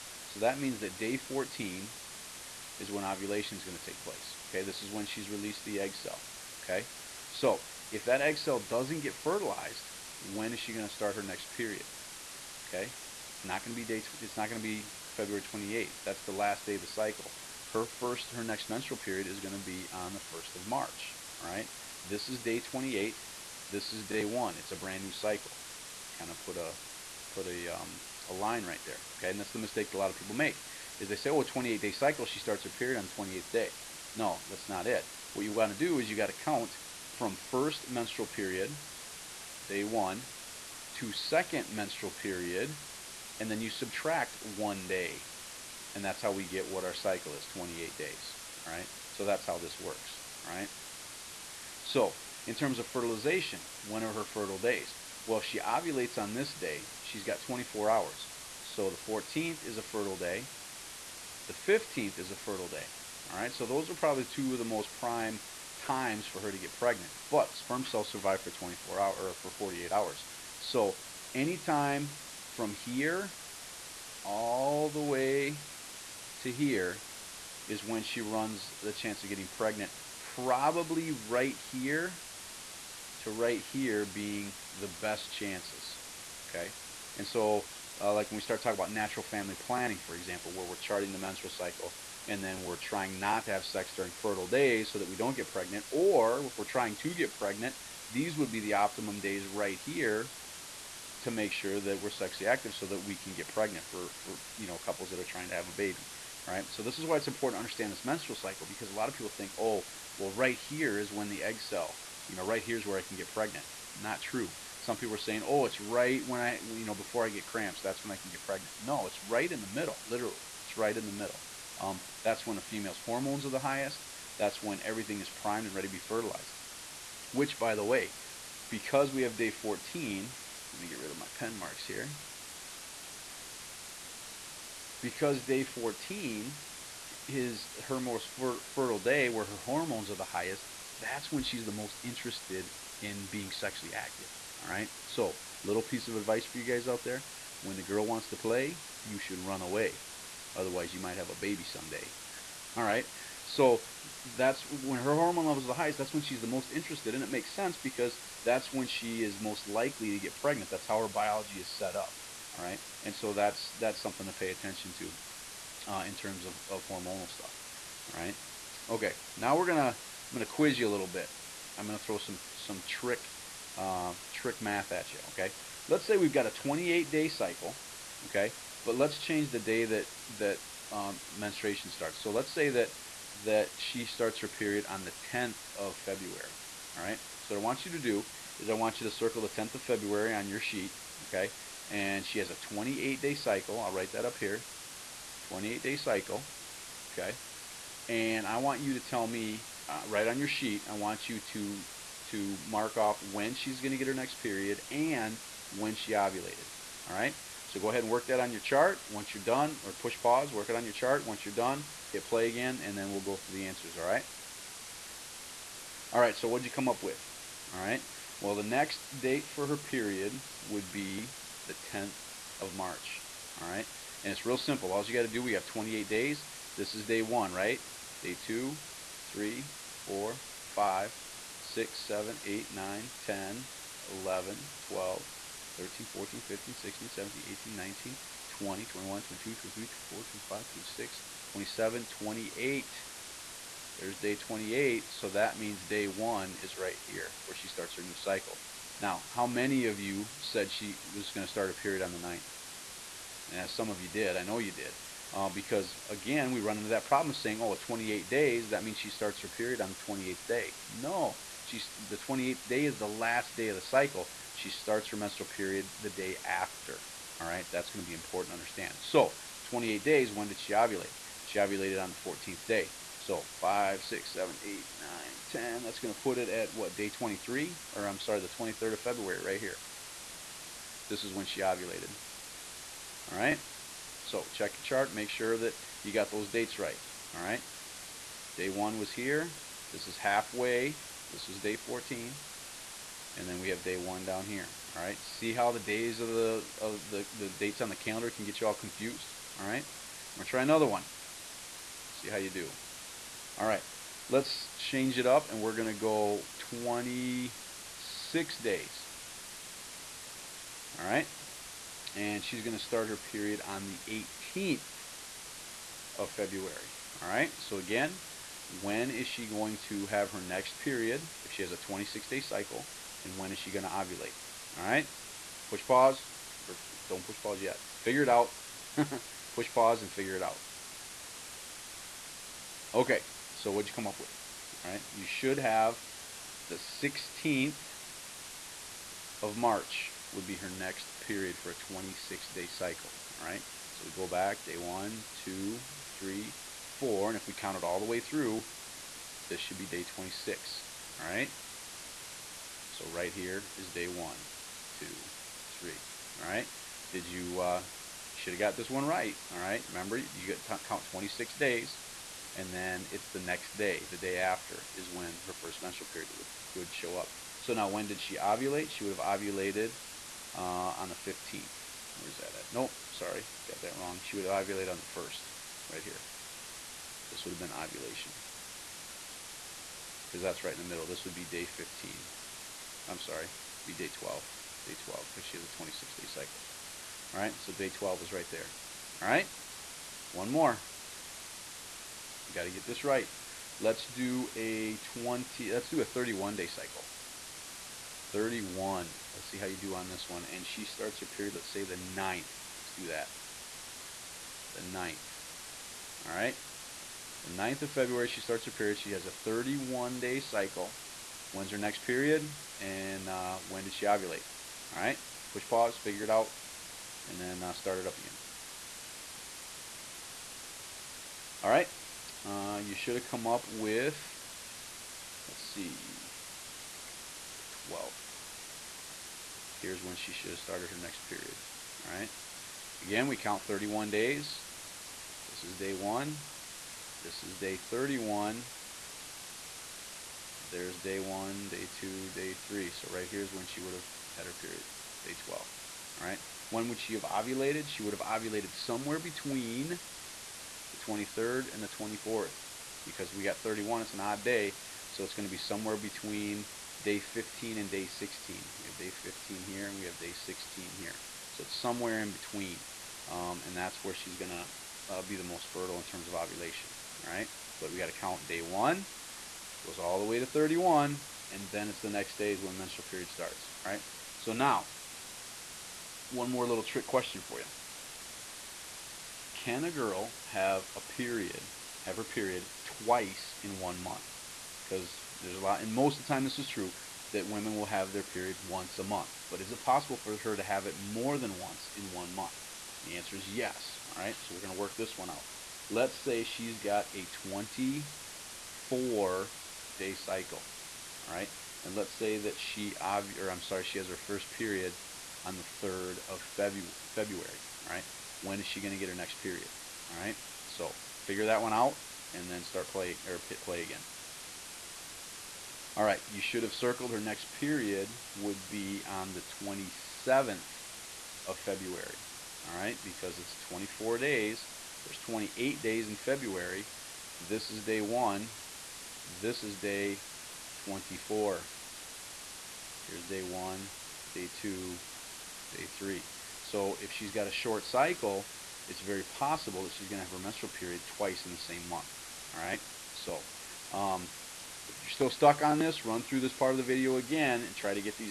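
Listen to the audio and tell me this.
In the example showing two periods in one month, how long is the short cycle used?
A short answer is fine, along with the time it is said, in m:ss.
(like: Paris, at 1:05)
24 days, at 8:17.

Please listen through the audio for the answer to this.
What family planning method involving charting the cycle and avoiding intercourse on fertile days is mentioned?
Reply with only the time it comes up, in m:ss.
1:28.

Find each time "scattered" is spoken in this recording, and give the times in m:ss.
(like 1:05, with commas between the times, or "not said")
not said.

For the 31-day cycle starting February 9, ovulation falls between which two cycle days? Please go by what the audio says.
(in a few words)
day 15 and day 16.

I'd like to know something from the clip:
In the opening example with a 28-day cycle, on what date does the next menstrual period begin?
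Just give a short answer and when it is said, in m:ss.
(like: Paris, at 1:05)
1st of March, at 0:20.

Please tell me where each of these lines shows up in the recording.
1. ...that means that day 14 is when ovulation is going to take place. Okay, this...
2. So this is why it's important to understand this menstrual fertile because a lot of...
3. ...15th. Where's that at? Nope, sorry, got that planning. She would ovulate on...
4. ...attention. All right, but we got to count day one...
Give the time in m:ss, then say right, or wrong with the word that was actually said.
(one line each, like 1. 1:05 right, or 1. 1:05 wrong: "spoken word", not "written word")
1. 0:00 right
2. 1:46 wrong: "cycle", not "fertile"
3. 6:11 wrong: "wrong", not "planning"
4. 7:46 wrong: "ovulation", not "attention".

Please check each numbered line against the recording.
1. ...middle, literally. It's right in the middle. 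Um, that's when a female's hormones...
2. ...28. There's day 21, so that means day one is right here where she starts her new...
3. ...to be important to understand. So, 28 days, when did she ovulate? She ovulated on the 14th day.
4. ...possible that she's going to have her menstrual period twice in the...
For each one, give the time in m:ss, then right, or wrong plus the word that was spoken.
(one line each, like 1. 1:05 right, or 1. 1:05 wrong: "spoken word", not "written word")
1. 1:59 right
2. 4:02 wrong: "28", not "21"
3. 4:28 right
4. 8:59 right.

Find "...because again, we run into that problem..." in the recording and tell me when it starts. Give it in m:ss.
4:15.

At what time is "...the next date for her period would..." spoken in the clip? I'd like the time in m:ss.
3:38.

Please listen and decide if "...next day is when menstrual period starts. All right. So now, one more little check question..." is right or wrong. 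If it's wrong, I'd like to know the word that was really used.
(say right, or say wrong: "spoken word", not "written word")
wrong: "trick", not "check".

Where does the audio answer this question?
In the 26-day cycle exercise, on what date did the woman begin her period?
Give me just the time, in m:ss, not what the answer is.
5:14.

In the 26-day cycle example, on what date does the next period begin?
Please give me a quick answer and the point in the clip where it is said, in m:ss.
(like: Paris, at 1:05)
16th of March, at 5:37.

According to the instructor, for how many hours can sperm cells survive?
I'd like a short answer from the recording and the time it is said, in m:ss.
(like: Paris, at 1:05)
48 hours, at 1:09.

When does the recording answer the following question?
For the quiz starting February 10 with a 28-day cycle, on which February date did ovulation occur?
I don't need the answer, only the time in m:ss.
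4:38.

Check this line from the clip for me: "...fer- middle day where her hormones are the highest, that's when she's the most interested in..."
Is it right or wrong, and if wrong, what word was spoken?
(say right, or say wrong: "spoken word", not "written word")
wrong: "fertile", not "middle".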